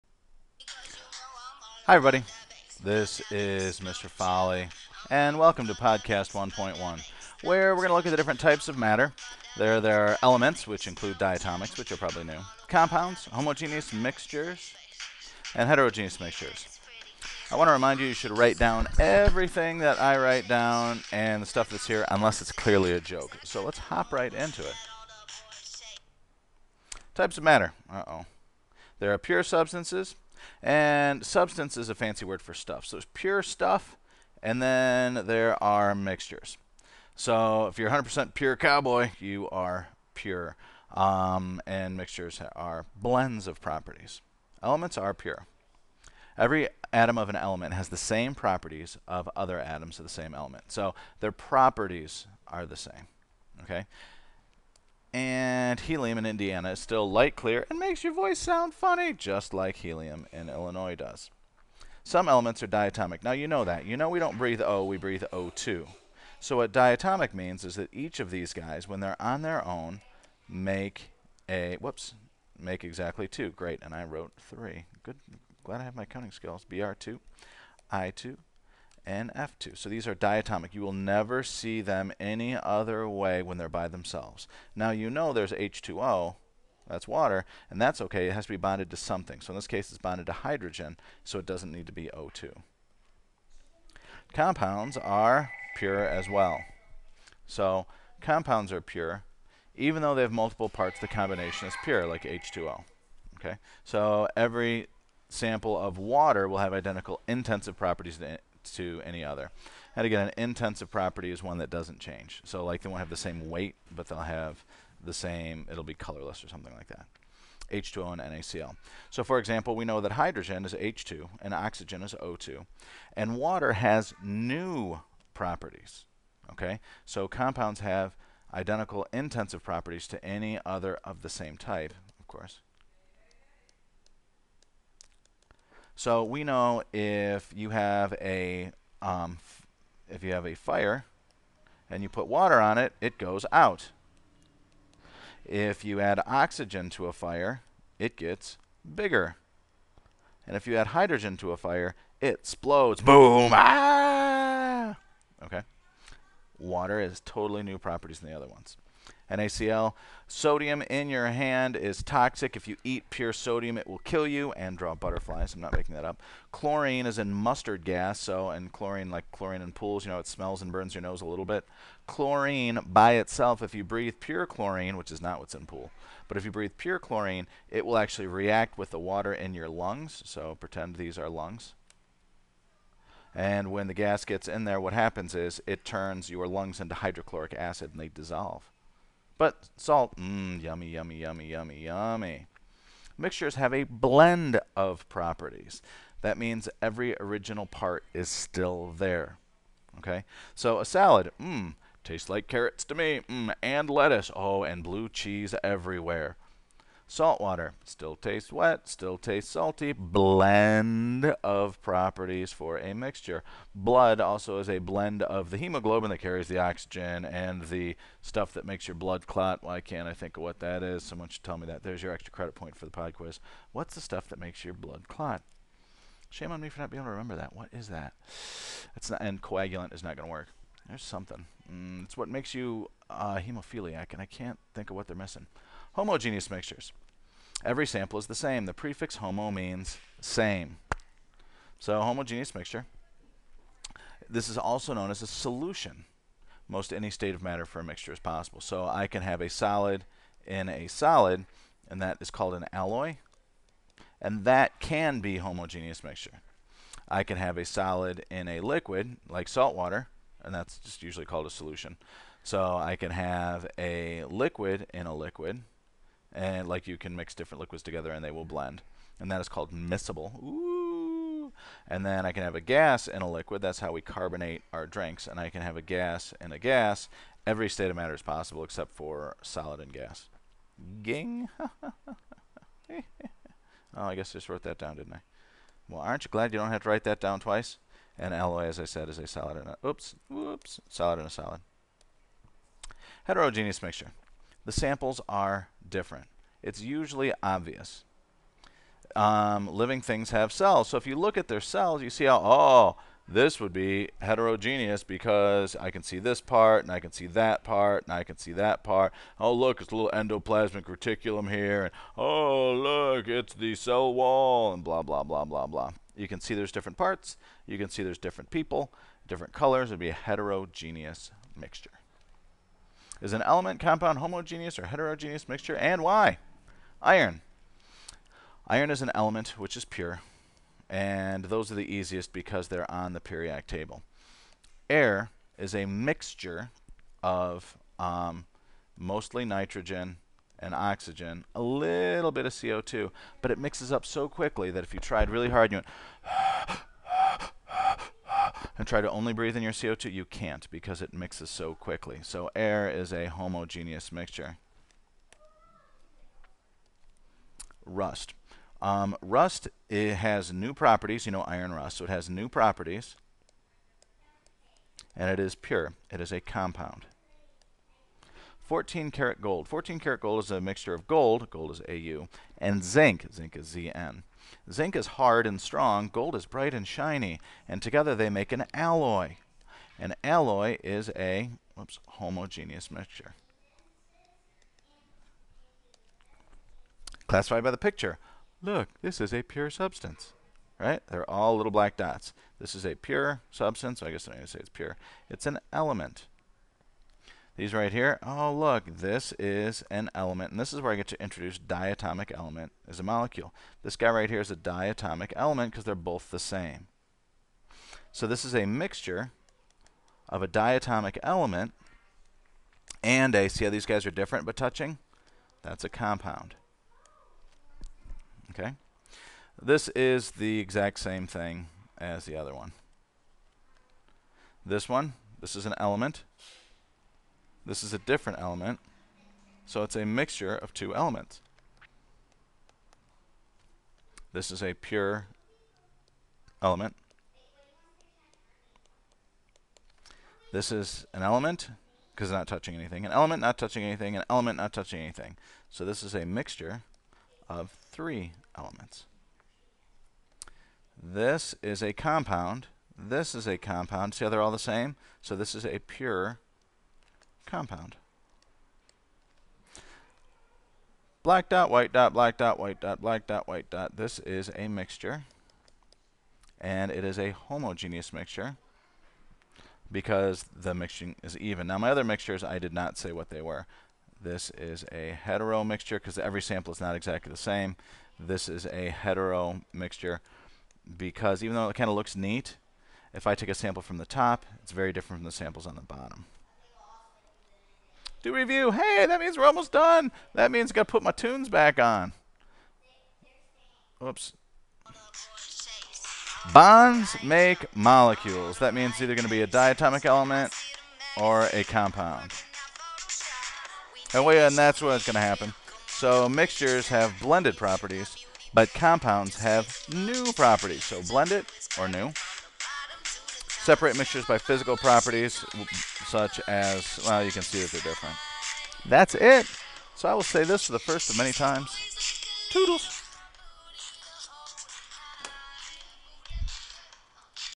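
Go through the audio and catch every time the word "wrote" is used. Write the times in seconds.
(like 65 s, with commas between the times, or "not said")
74 s, 284 s.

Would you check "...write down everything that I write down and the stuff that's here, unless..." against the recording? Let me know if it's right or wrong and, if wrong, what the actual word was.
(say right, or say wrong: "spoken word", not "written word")
right.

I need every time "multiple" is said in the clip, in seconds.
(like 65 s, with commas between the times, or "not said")
100 s.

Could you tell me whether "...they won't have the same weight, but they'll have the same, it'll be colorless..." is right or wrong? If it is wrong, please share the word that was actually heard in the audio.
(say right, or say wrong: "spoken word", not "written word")
right.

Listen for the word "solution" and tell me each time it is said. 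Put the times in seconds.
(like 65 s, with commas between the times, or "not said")
245 s, 261 s.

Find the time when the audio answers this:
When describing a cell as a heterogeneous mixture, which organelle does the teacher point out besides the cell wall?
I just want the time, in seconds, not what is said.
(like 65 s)
310 s.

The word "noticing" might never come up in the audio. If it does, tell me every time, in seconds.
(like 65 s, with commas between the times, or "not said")
not said.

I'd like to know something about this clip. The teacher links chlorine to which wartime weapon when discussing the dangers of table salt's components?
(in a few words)
mustard gas.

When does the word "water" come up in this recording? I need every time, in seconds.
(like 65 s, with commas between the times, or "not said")
87 s, 105 s, 123 s, 142 s, 156 s, 178 s, 207 s, 259 s.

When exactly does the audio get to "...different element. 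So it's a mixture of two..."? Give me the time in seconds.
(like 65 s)
427 s.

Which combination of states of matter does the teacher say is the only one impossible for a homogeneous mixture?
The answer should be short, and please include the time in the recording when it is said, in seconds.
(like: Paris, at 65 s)
solid and gas, at 279 s.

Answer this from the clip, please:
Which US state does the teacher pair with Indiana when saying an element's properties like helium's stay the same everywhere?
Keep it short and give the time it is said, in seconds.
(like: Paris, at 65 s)
Illinois, at 60 s.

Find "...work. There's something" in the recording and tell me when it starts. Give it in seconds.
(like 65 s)
230 s.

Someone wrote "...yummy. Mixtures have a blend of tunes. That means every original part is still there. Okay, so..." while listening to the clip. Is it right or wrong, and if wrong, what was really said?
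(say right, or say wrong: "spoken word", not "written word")
wrong: "properties", not "tunes".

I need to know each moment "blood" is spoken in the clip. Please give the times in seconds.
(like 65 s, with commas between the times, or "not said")
213 s, 218 s, 224 s.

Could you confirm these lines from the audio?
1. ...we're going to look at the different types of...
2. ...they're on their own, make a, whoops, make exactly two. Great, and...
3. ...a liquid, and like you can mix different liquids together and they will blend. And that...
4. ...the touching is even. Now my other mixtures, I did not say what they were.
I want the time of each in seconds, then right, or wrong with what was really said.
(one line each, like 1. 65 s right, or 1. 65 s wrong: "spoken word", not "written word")
1. 7 s right
2. 69 s right
3. 265 s right
4. 470 s wrong: "mixing", not "touching".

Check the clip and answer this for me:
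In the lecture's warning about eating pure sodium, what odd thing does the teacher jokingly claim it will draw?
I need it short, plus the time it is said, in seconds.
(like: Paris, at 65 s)
butterflies, at 164 s.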